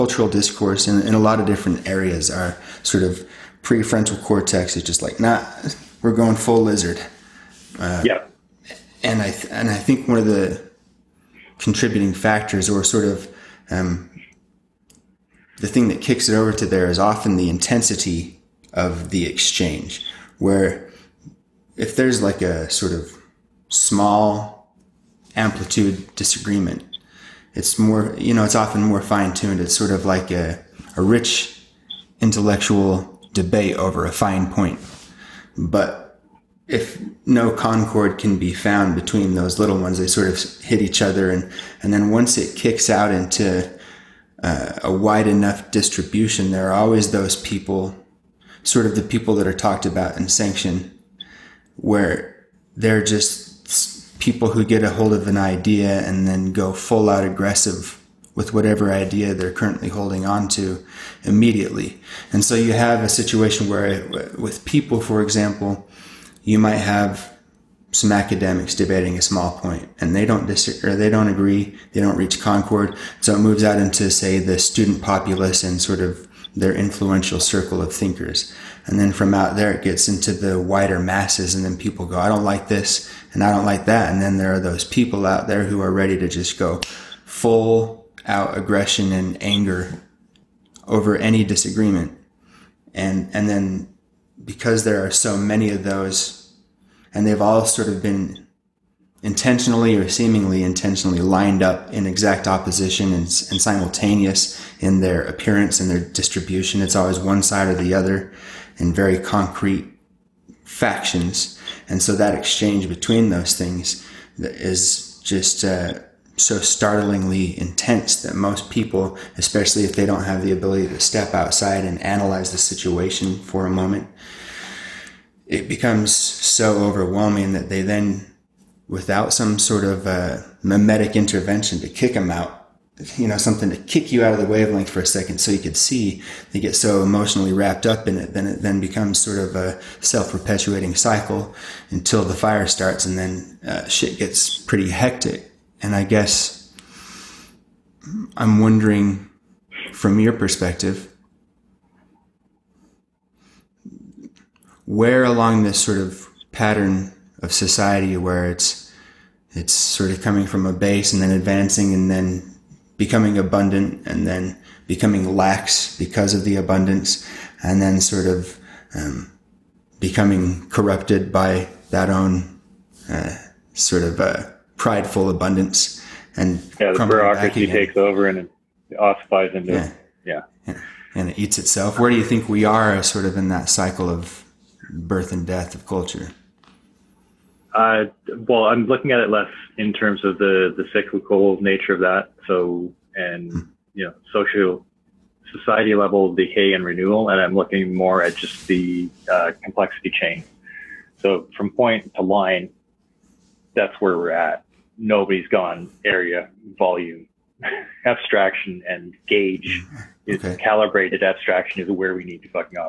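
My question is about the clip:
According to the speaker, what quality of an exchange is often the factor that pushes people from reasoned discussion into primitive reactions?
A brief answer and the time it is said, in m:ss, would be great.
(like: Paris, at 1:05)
intensity, at 0:17.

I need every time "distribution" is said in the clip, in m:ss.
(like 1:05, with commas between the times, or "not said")
0:45, 1:45.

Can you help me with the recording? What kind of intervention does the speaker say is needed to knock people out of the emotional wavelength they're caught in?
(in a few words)
mimetic intervention.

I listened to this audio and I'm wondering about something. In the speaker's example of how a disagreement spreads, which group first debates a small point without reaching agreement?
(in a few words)
academics.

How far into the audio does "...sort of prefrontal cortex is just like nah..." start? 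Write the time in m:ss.
0:02.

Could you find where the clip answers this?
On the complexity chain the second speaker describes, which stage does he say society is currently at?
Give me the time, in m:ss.
3:22.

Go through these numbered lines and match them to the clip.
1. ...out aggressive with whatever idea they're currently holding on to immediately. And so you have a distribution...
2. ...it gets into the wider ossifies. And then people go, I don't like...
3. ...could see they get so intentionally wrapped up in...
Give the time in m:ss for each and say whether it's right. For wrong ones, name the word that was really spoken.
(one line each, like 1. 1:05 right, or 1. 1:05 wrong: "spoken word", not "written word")
1. 0:57 wrong: "situation", not "distribution"
2. 1:19 wrong: "masses", not "ossifies"
3. 2:15 wrong: "emotionally", not "intentionally".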